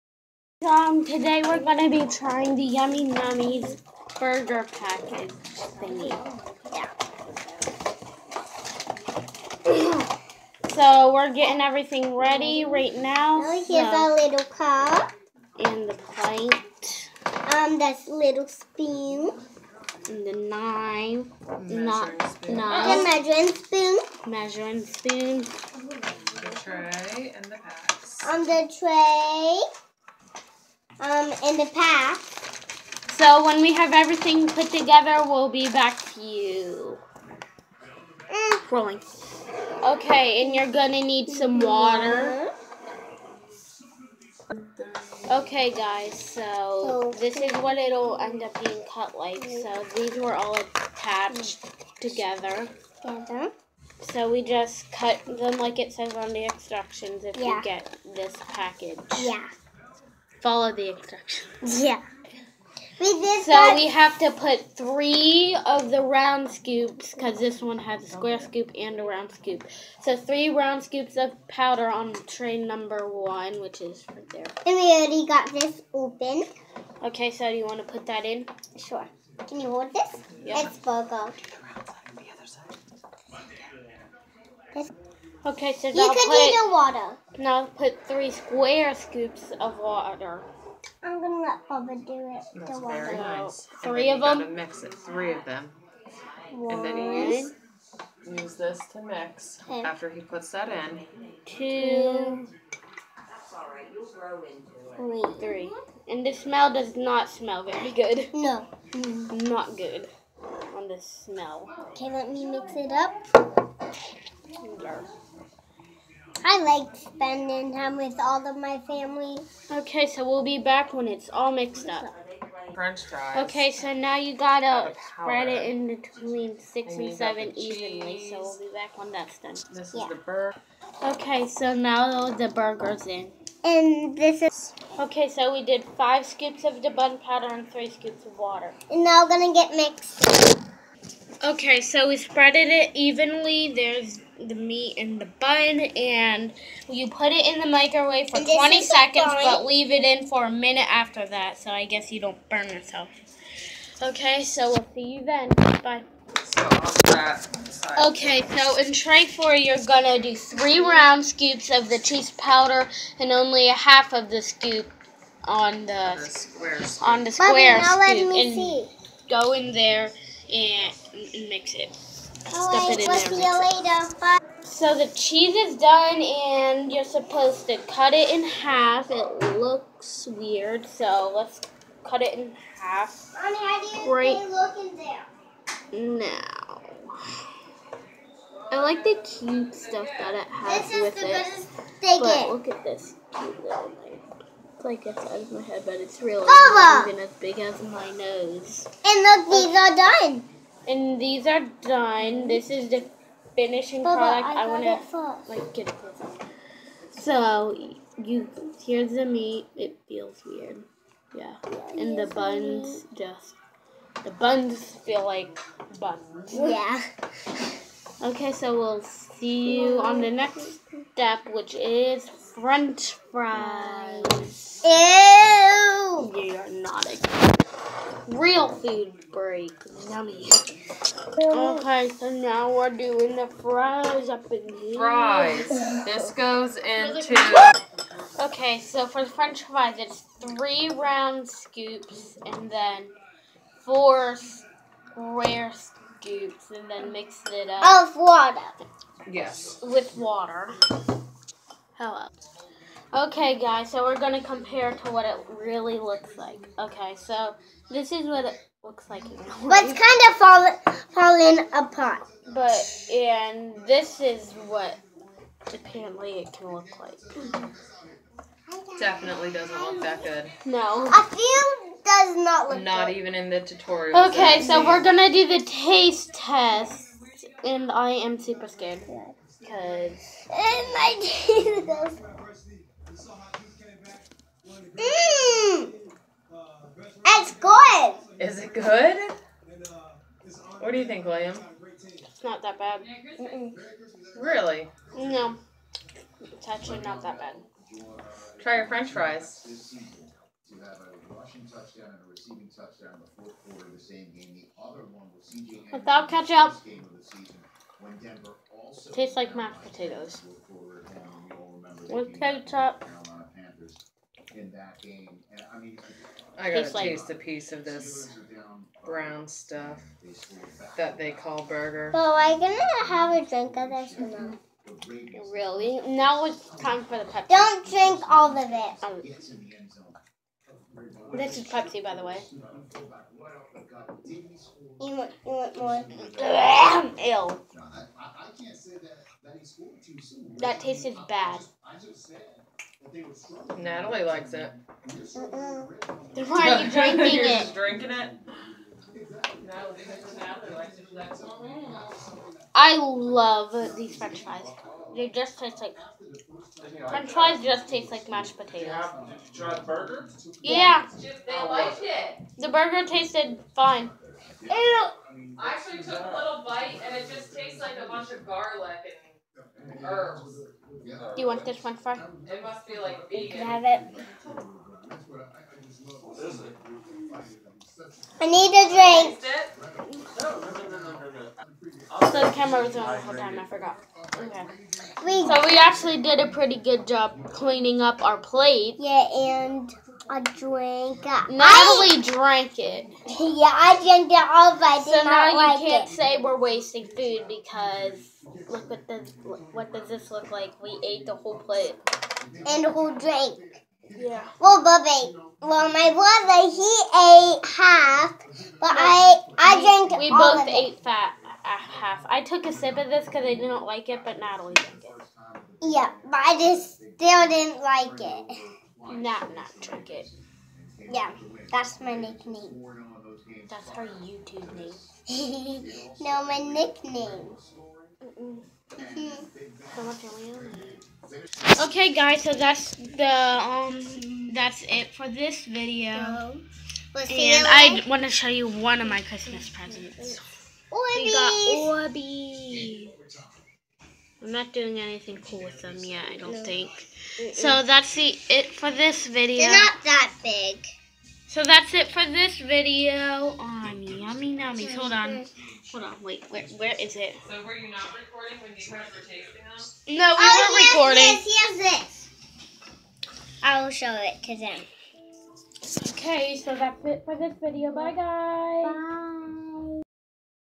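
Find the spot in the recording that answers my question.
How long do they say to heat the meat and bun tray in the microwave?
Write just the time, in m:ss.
2:28.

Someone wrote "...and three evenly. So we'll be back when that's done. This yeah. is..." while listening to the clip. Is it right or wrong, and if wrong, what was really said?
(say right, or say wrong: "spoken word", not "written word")
wrong: "seven", not "three".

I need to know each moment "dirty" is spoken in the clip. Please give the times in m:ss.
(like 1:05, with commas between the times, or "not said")
not said.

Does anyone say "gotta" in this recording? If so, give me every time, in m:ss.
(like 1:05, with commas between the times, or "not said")
2:04, 5:16.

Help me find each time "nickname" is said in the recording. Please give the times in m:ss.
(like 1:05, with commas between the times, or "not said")
7:02, 7:06.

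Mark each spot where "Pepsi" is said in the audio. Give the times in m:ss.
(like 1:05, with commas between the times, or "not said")
5:27, 5:31.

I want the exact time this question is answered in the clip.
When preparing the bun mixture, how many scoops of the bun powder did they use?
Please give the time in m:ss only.
2:15.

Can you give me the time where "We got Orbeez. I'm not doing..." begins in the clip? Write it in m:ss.
7:21.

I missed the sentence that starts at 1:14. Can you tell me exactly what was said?
And we already got this open.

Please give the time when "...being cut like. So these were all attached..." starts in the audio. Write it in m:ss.
0:48.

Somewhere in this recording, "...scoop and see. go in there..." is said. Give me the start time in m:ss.
2:48.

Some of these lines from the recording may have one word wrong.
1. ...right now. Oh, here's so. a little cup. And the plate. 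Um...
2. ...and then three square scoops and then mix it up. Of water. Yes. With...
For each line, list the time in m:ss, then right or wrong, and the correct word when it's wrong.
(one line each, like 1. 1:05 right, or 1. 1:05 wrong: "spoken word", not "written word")
1. 0:12 right
2. 4:02 wrong: "four", not "three".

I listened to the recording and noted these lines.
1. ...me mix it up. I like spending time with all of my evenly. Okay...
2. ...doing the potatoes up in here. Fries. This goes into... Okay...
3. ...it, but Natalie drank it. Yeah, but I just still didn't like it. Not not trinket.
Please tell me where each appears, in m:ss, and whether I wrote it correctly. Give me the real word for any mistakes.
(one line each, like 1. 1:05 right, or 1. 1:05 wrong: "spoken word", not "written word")
1. 1:52 wrong: "family", not "evenly"
2. 3:52 wrong: "fries", not "potatoes"
3. 6:54 right.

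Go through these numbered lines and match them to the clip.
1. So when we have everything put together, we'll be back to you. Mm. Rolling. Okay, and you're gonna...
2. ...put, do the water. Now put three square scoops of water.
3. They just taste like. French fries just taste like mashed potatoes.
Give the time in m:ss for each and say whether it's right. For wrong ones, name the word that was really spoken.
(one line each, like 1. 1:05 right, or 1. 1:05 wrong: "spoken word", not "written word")
1. 0:33 right
2. 1:26 right
3. 5:55 right.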